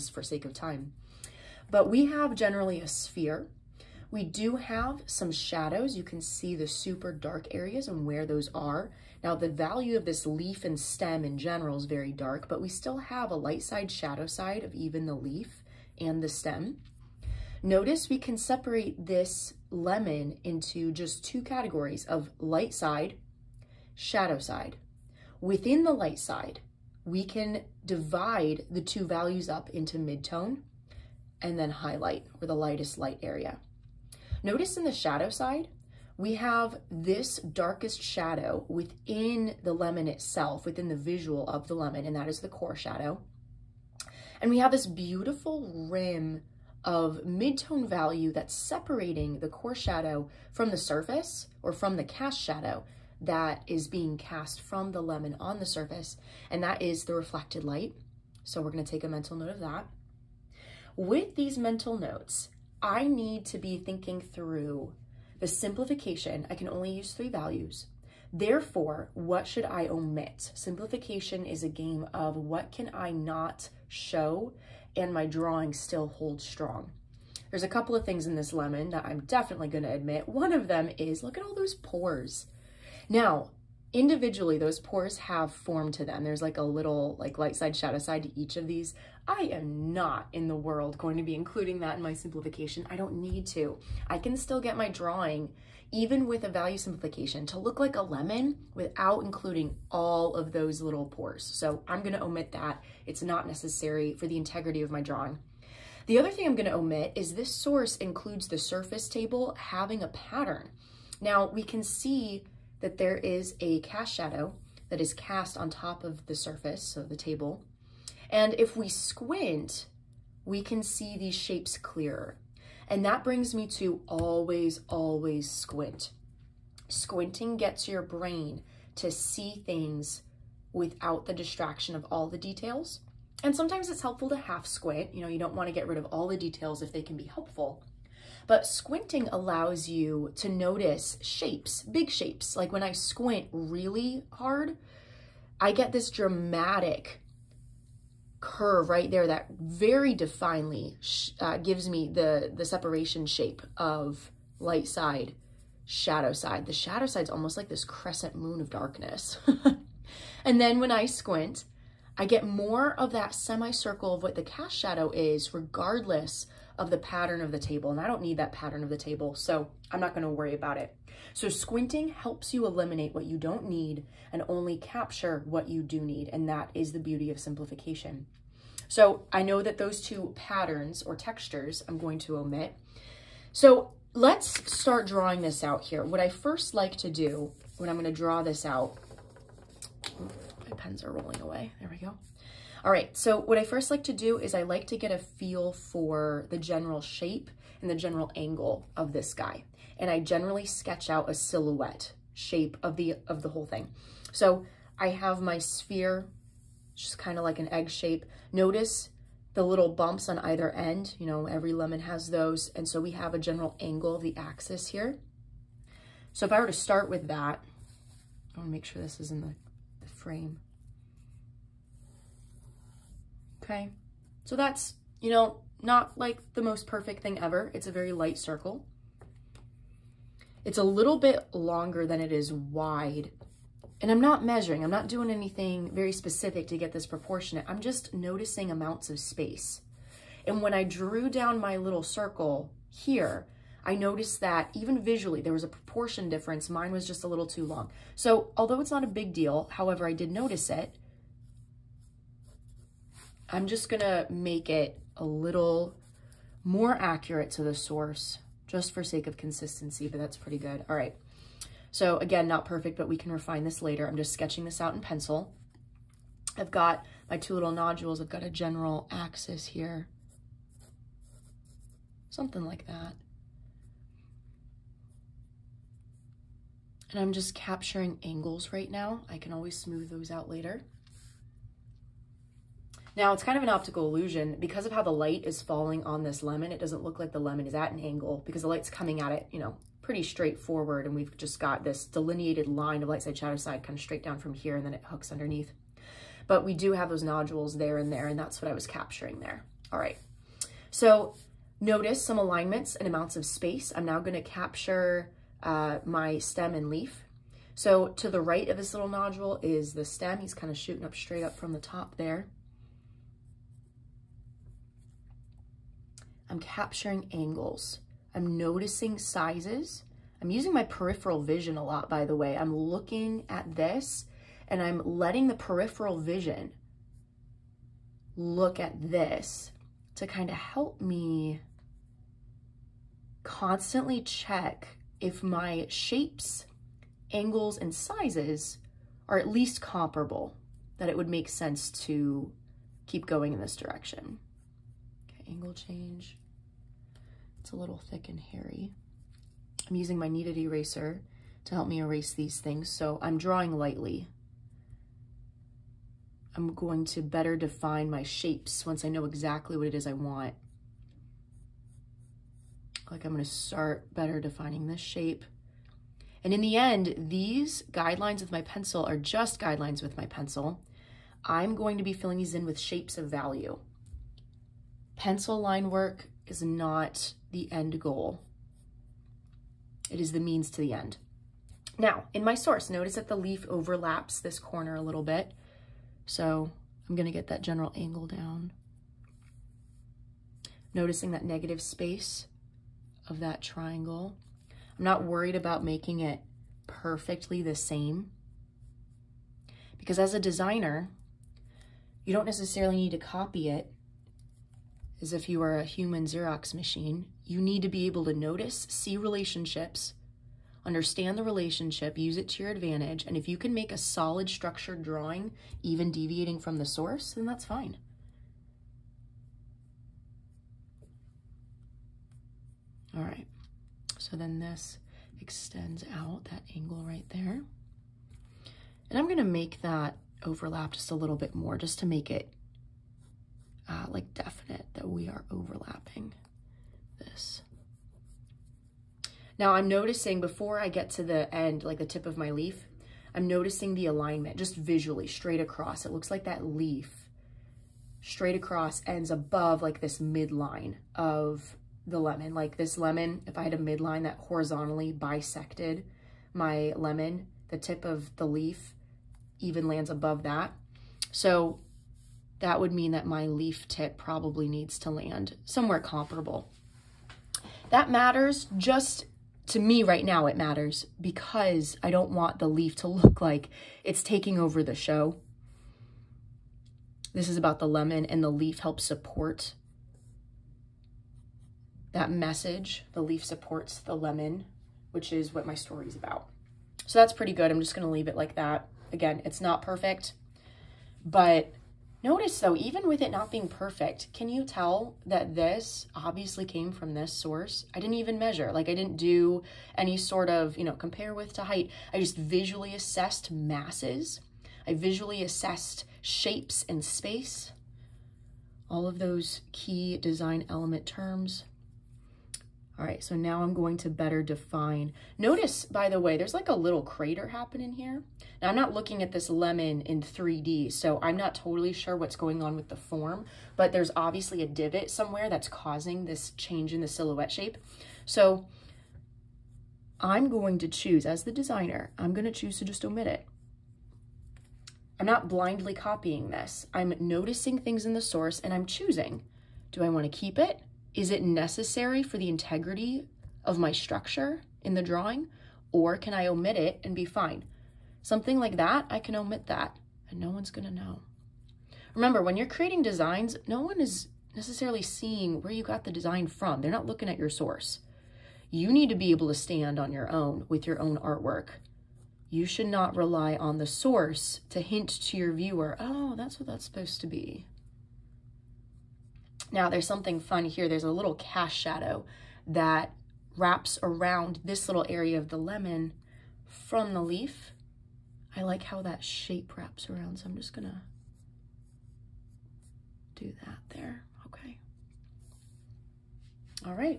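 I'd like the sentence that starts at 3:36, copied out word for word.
So if I were to start with that, I wanna make sure this is in the, the frame okay?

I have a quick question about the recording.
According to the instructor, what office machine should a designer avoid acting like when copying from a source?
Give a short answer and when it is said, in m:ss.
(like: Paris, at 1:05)
Xerox machine, at 6:46.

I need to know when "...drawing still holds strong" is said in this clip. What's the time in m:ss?
1:15.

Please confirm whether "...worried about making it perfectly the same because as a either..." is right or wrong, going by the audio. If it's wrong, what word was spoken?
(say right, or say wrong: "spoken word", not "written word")
wrong: "designer", not "either".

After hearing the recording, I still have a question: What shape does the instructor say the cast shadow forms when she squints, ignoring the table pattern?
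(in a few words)
semicircle.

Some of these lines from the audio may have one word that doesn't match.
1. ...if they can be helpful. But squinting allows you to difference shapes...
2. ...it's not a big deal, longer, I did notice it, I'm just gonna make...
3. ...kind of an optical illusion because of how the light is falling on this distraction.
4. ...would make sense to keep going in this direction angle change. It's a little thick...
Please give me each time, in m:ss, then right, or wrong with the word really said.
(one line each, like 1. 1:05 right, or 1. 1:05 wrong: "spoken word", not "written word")
1. 2:16 wrong: "notice", not "difference"
2. 4:08 wrong: "however", not "longer"
3. 4:43 wrong: "lemon", not "distraction"
4. 5:41 right.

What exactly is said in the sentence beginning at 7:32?
Like this lemon, if I had a midline that horizontally bisected my lemon, the tip of the leaf even lands above that.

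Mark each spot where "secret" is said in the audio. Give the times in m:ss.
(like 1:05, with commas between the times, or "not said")
not said.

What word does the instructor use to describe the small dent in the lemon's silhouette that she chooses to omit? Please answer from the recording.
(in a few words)
crater.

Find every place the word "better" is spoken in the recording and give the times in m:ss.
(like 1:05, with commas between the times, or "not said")
5:57, 6:04, 8:34.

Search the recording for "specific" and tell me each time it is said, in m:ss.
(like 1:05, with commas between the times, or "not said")
3:56.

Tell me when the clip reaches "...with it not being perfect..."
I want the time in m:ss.
8:13.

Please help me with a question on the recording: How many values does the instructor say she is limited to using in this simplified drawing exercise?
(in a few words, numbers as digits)
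3.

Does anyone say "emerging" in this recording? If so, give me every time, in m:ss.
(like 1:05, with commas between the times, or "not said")
not said.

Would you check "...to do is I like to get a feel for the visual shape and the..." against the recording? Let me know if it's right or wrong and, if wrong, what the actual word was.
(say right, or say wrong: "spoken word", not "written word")
wrong: "general", not "visual".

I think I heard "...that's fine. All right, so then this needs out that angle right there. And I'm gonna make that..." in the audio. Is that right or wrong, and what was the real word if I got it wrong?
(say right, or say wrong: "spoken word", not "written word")
wrong: "extends", not "needs".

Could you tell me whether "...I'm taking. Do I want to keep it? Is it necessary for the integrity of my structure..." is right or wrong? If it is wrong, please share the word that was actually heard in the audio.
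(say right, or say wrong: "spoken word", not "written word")
wrong: "choosing", not "taking".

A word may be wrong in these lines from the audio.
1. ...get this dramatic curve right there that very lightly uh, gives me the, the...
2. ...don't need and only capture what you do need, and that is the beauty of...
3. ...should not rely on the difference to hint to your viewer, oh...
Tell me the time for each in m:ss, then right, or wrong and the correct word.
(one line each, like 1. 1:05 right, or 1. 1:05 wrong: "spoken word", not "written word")
1. 2:25 wrong: "definely", not "lightly"
2. 2:53 right
3. 9:22 wrong: "source", not "difference".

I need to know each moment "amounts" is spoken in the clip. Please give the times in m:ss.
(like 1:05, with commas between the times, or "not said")
3:58, 5:03.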